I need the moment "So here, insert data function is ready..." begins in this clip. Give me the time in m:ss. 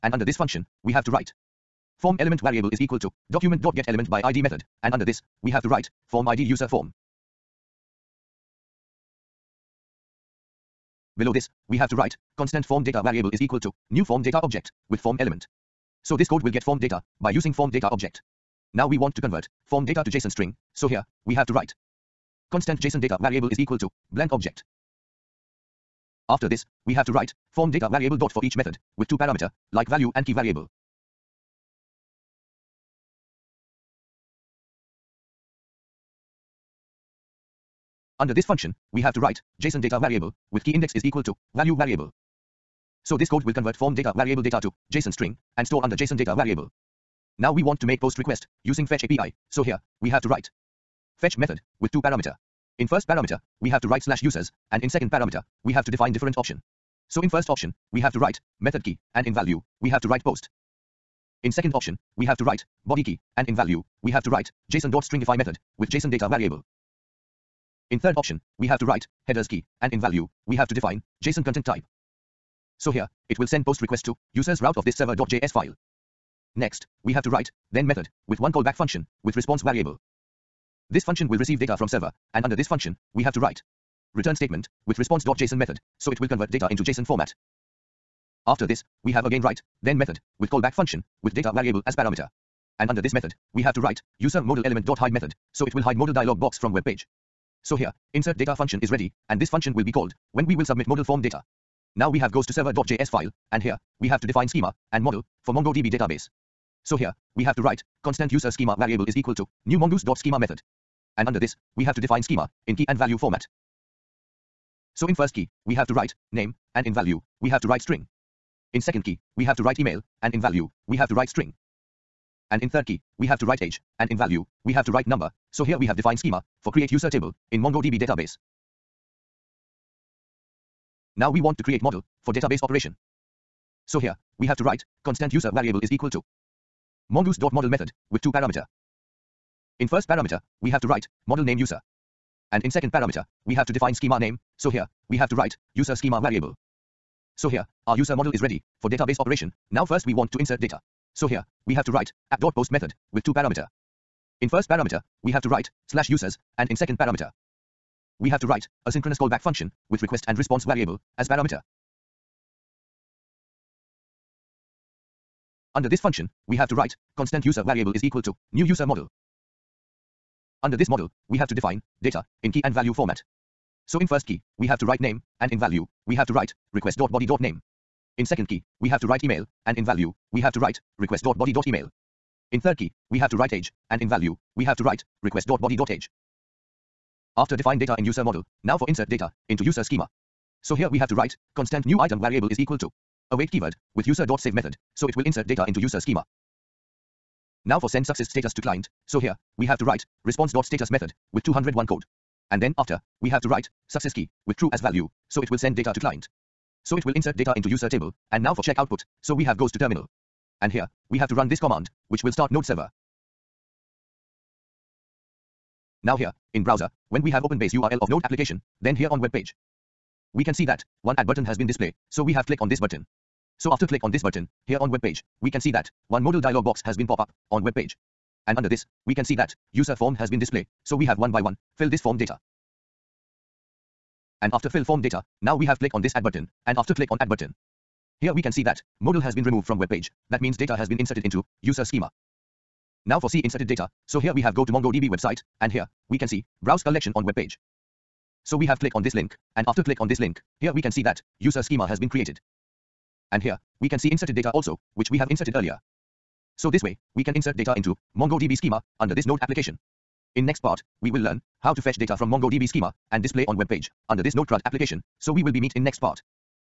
1:37.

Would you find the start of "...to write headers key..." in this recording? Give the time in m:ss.
1:08.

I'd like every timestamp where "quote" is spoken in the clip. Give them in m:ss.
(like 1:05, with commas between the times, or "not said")
not said.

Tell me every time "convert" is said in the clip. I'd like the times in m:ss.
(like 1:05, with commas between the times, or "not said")
0:19, 0:43, 1:26.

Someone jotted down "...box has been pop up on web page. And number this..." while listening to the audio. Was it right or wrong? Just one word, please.
wrong.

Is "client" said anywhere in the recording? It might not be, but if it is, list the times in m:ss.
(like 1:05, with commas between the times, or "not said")
3:18, 3:25.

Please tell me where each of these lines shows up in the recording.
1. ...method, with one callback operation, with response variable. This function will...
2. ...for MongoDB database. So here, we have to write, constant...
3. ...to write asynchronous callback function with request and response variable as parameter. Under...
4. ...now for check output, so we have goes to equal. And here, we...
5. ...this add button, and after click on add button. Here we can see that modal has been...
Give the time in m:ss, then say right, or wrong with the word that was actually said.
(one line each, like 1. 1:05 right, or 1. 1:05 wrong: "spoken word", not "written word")
1. 1:17 wrong: "function", not "operation"
2. 1:45 right
3. 2:38 right
4. 3:28 wrong: "terminal", not "equal"
5. 3:56 right.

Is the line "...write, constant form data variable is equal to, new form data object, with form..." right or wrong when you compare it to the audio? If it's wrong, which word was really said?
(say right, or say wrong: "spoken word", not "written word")
right.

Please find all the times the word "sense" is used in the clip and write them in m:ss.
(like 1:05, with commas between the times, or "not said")
not said.